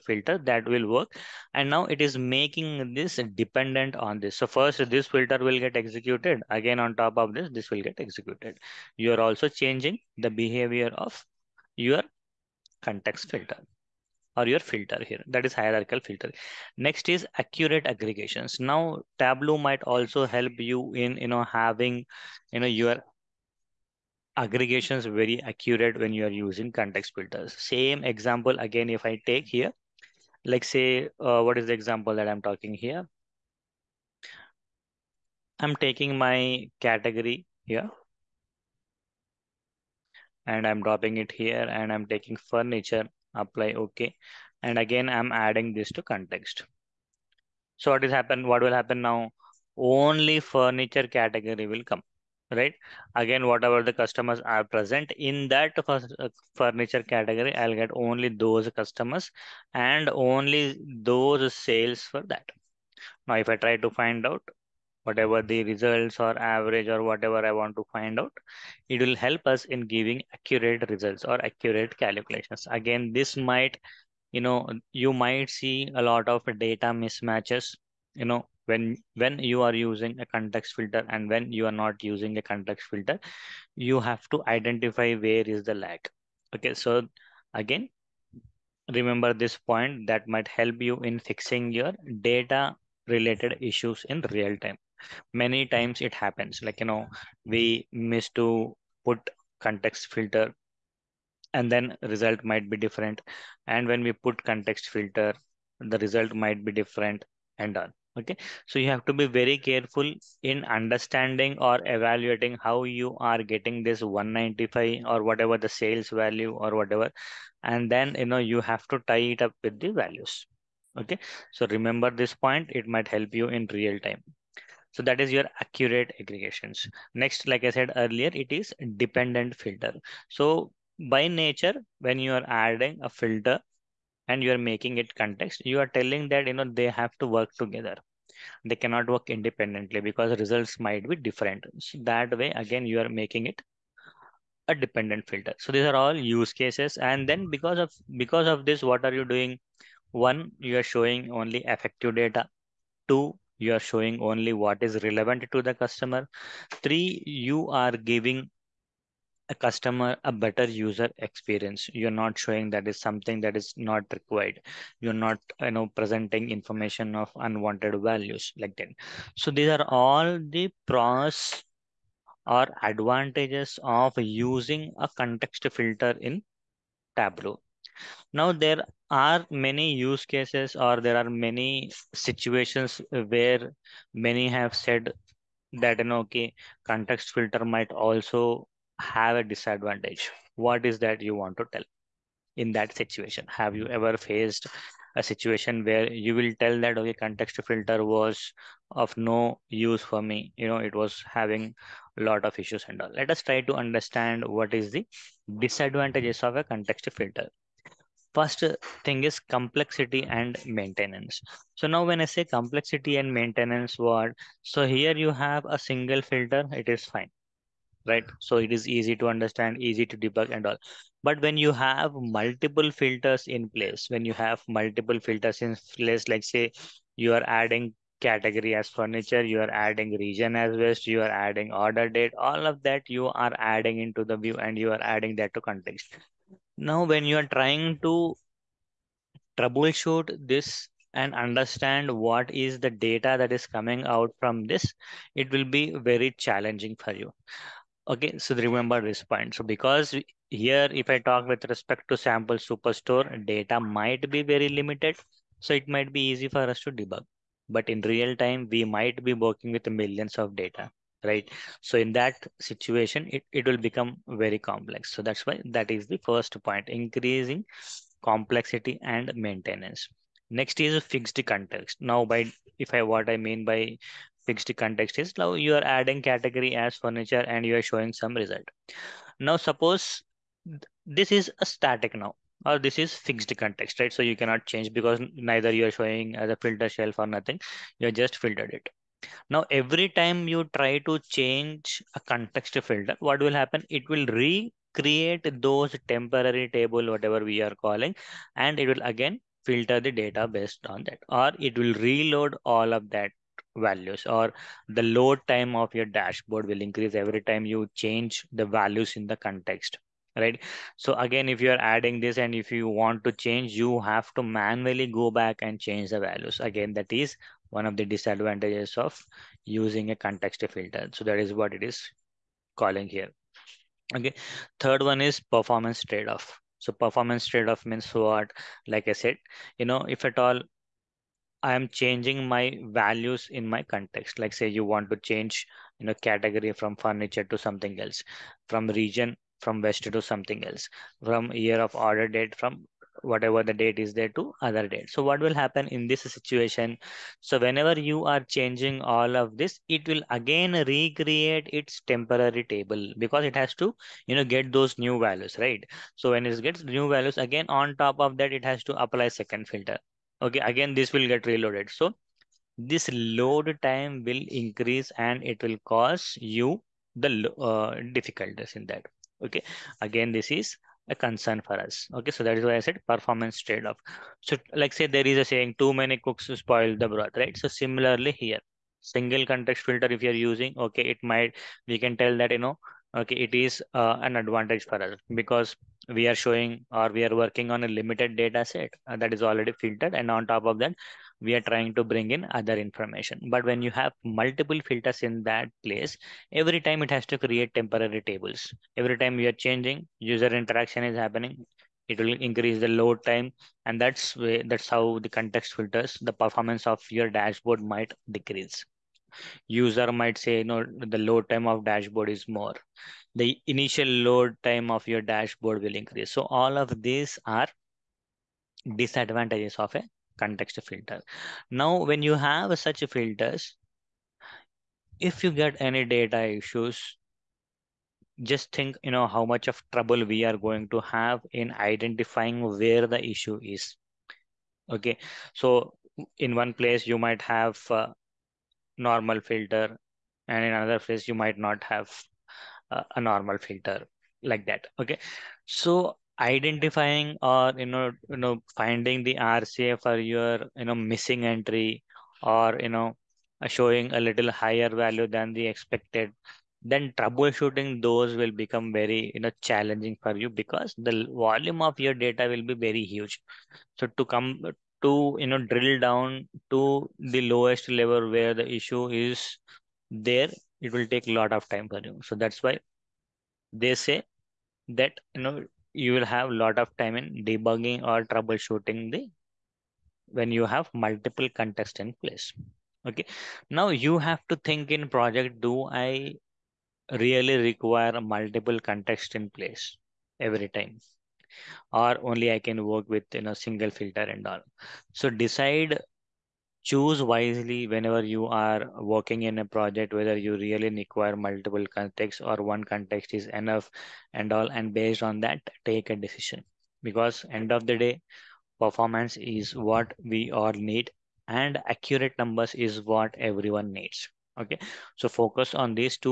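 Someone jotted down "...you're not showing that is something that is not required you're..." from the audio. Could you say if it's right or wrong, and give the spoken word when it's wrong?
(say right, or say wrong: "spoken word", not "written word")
right.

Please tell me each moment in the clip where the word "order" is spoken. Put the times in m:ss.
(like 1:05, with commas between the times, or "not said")
3:51, 5:41.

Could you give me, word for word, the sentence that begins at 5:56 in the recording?
So when it gets new values, again, on top of that, it has to apply second filter.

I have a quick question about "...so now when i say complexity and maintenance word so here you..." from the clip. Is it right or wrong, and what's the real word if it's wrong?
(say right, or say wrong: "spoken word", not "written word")
right.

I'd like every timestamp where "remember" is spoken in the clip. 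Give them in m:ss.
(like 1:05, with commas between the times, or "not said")
1:28, 2:01, 4:08.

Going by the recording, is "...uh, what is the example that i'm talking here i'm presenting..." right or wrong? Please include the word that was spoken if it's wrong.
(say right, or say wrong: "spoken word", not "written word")
wrong: "taking", not "presenting".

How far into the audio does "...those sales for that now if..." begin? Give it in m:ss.
1:01.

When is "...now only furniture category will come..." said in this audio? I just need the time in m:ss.
0:49.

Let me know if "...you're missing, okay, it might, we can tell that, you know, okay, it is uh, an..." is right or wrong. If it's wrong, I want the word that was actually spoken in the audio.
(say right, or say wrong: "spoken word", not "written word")
wrong: "using", not "missing".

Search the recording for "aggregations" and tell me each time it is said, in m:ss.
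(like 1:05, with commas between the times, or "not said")
0:17, 0:24, 2:06.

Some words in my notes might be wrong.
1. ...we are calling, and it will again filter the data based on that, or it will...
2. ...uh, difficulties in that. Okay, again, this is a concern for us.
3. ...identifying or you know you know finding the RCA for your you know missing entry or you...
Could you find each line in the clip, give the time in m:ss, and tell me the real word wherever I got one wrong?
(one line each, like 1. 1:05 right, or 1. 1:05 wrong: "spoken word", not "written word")
1. 4:57 right
2. 6:07 right
3. 7:26 right.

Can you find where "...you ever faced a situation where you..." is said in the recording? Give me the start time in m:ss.
3:13.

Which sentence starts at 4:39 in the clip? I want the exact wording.
Now, suppose this is a static now or this is fixed context, right?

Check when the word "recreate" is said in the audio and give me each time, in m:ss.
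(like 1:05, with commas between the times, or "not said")
4:54, 5:50.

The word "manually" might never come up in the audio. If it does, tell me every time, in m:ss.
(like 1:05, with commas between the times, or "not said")
5:14.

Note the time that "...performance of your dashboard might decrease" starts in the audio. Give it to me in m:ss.
6:46.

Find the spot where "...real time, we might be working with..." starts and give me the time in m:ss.
4:18.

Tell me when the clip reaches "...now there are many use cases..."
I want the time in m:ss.
2:58.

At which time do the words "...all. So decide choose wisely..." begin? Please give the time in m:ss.
8:14.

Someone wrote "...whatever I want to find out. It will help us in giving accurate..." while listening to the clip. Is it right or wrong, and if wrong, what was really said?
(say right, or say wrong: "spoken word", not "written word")
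right.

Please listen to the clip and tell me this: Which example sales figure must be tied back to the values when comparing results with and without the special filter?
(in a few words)
195.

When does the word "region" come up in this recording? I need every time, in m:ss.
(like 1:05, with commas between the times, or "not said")
3:50, 5:38.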